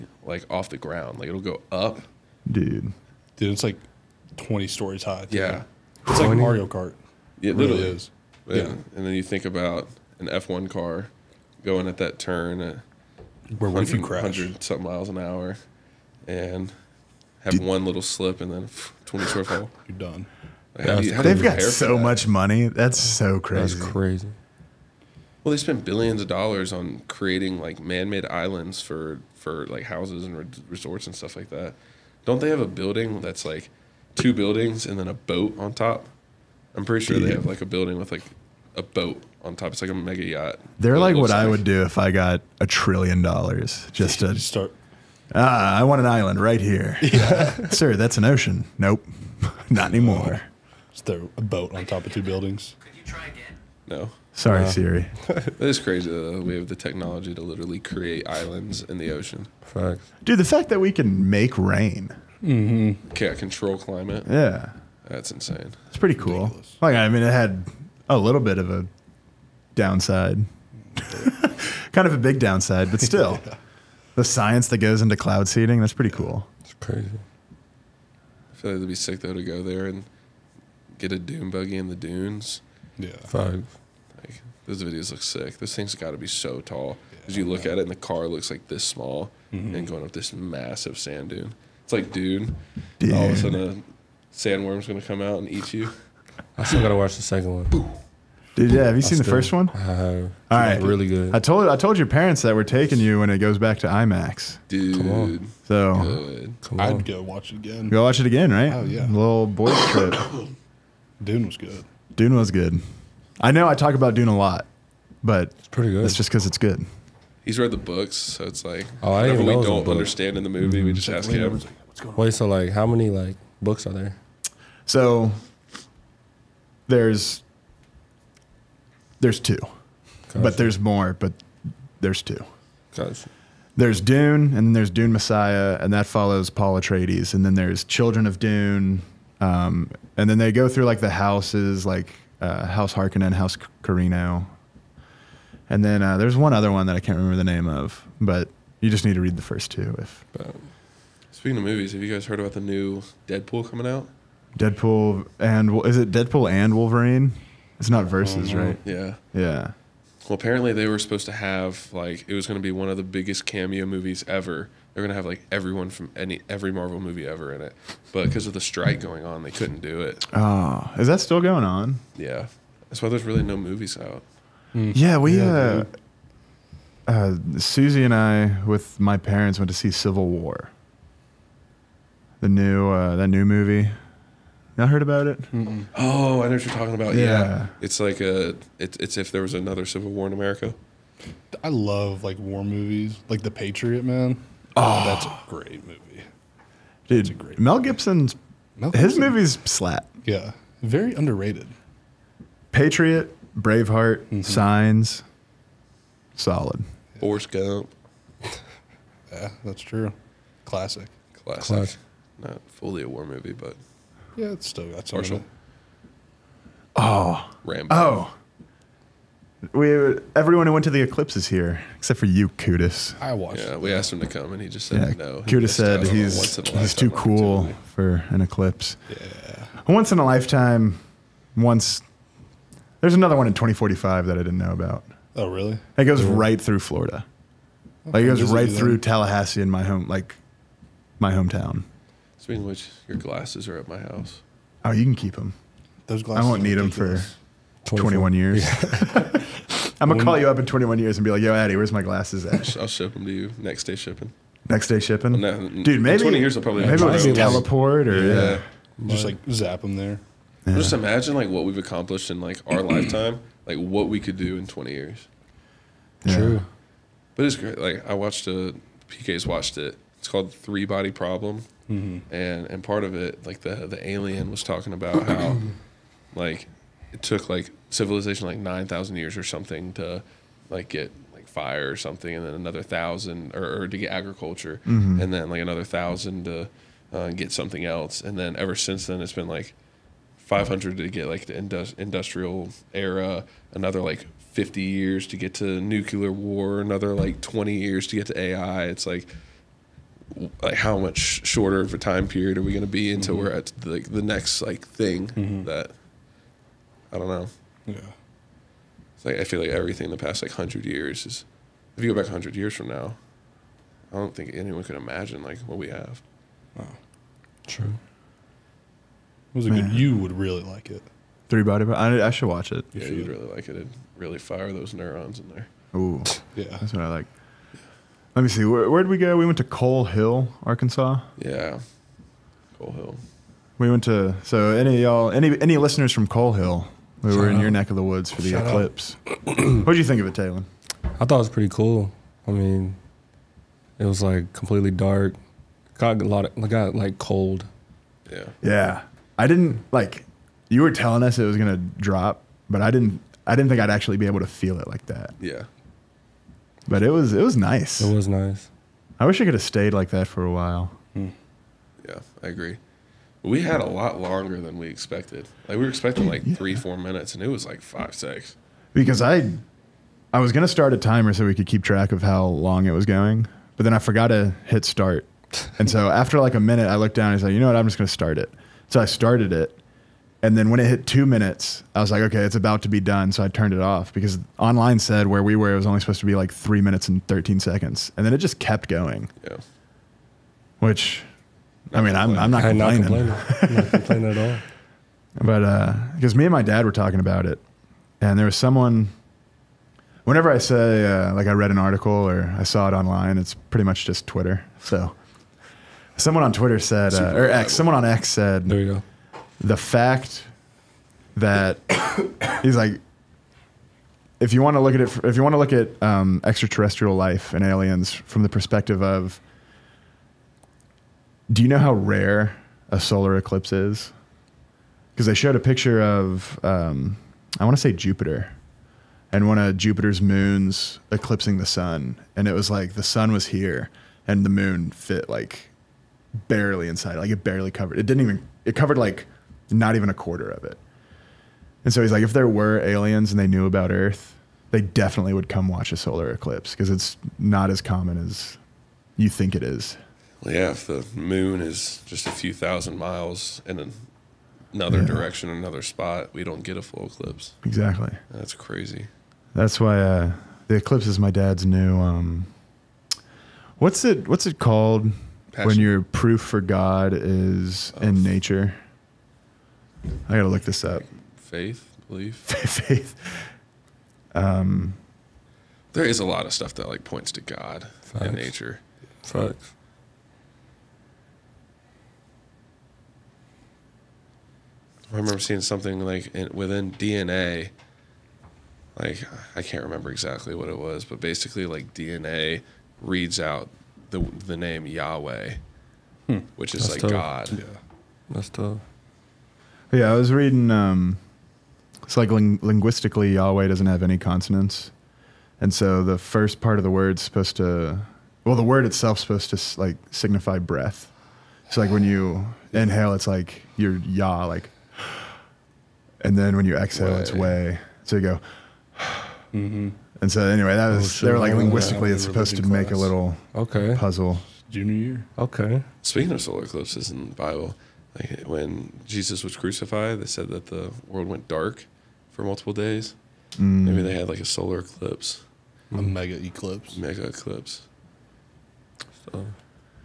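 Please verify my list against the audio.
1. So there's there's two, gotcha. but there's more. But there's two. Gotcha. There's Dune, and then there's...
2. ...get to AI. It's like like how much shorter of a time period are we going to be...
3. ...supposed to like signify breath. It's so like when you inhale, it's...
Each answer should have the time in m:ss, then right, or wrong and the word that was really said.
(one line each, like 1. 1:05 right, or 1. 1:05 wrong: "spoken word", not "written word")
1. 2:04 right
2. 4:58 right
3. 8:29 right.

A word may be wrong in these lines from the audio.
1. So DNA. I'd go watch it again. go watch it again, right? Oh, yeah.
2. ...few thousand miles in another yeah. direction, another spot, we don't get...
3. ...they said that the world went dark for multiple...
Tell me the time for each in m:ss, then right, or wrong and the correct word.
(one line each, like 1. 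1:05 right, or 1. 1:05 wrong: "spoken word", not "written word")
1. 1:45 wrong: "Good", not "DNA"
2. 7:32 right
3. 8:50 right.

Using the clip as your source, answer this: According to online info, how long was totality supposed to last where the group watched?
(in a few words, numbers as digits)
3 minutes 13 seconds.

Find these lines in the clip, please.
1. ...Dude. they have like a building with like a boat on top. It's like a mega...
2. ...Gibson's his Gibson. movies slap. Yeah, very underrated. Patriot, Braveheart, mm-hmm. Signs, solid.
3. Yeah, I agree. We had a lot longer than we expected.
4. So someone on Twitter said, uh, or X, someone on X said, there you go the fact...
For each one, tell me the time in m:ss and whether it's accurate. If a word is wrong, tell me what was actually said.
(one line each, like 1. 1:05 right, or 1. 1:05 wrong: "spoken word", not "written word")
1. 0:37 right
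2. 3:17 right
3. 6:02 right
4. 6:44 right.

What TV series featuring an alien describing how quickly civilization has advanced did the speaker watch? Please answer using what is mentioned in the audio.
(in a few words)
Three Body Problem.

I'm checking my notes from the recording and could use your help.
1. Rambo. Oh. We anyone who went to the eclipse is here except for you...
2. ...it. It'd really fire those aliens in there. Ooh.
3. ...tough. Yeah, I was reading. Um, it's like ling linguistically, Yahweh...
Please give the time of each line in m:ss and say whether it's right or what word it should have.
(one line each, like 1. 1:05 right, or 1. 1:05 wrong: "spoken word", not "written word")
1. 3:37 wrong: "everyone", not "anyone"
2. 5:23 wrong: "neurons", not "aliens"
3. 8:18 right.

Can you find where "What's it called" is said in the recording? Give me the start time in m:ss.
7:44.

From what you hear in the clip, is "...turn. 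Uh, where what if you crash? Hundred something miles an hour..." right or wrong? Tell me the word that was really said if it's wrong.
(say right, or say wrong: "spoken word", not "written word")
right.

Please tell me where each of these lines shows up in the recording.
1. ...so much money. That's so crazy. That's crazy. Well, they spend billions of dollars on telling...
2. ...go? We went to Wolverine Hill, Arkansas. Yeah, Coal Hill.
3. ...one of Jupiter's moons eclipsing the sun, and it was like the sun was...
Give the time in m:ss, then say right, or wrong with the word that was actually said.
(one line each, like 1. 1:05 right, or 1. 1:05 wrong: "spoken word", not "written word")
1. 0:21 wrong: "creating", not "telling"
2. 5:29 wrong: "Coal", not "Wolverine"
3. 7:09 right.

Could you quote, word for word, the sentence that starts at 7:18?
It covered like not even a quarter of it.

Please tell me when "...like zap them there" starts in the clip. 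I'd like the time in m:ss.
4:19.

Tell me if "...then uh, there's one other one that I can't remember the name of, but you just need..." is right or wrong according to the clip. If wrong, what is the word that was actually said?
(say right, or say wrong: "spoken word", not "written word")
right.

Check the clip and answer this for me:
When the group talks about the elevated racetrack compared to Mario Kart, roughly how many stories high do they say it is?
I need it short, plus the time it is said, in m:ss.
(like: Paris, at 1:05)
20, at 0:04.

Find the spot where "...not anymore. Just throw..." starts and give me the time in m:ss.
0:49.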